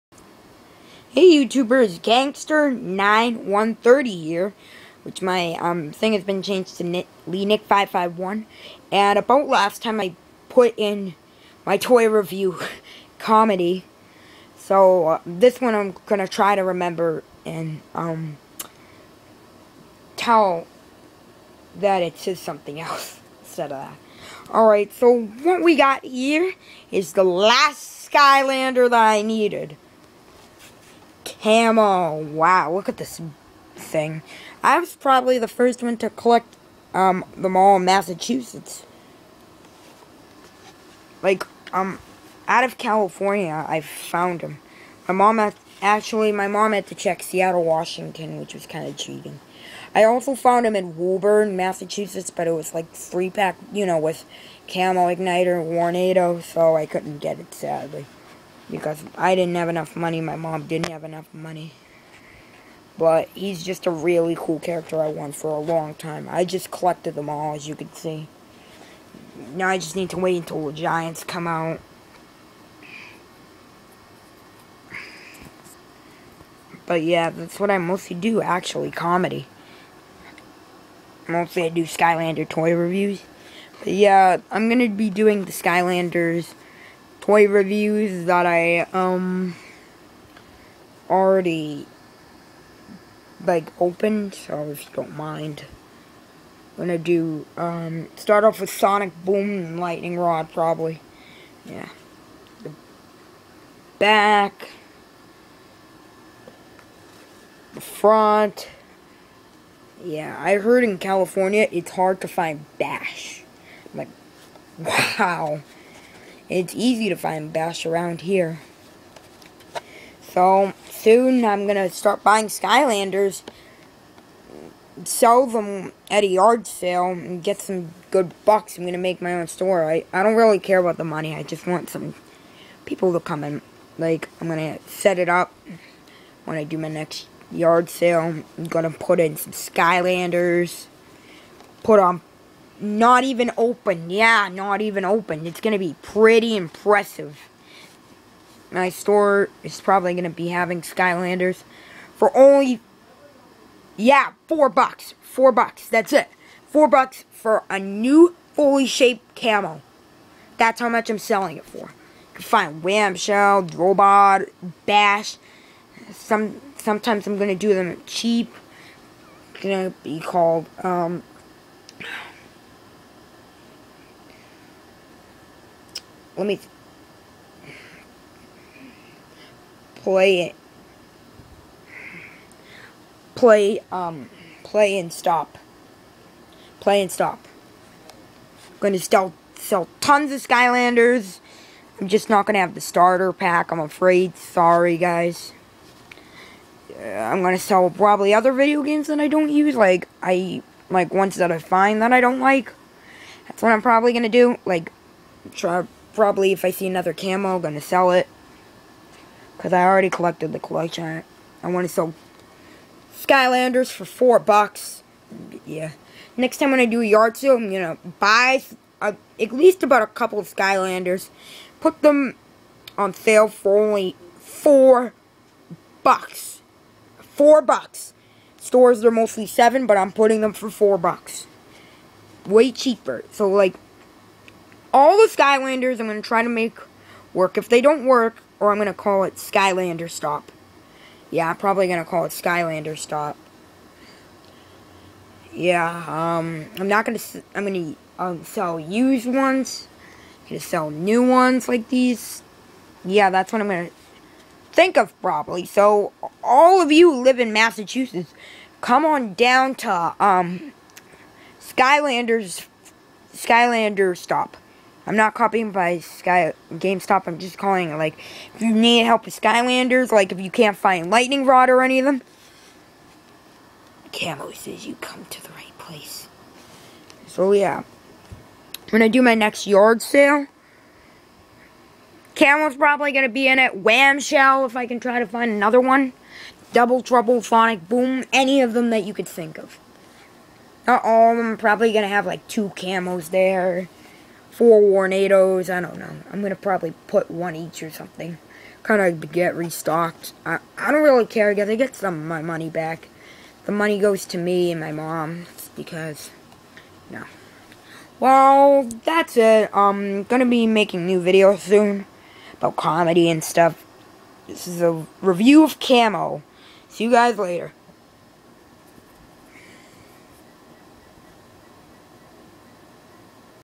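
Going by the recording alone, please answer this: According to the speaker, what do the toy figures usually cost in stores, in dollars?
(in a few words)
7.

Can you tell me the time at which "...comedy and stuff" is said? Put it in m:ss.
5:12.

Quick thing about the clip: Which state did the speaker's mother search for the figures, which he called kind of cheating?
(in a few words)
Washington.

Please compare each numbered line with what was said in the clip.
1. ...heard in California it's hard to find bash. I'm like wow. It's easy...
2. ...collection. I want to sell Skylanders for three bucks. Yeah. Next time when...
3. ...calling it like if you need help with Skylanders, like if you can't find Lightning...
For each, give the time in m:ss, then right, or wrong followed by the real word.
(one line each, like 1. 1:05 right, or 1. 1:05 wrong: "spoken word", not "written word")
1. 1:50 right
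2. 3:30 wrong: "four", not "three"
3. 4:27 right.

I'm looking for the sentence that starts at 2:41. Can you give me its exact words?
You can find Wham Shell, Robot, Bash.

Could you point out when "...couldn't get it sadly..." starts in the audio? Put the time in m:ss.
0:56.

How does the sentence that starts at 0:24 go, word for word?
Alright, so what we got here is the last Skylander that I needed.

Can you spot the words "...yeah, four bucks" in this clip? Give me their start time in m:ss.
2:33.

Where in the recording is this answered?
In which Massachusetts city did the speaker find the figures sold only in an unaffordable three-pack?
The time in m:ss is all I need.
0:50.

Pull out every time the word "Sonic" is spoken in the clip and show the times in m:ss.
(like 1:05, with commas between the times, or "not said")
1:38, 4:47.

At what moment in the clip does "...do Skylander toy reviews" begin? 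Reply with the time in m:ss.
1:21.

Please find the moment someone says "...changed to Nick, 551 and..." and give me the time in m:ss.
0:06.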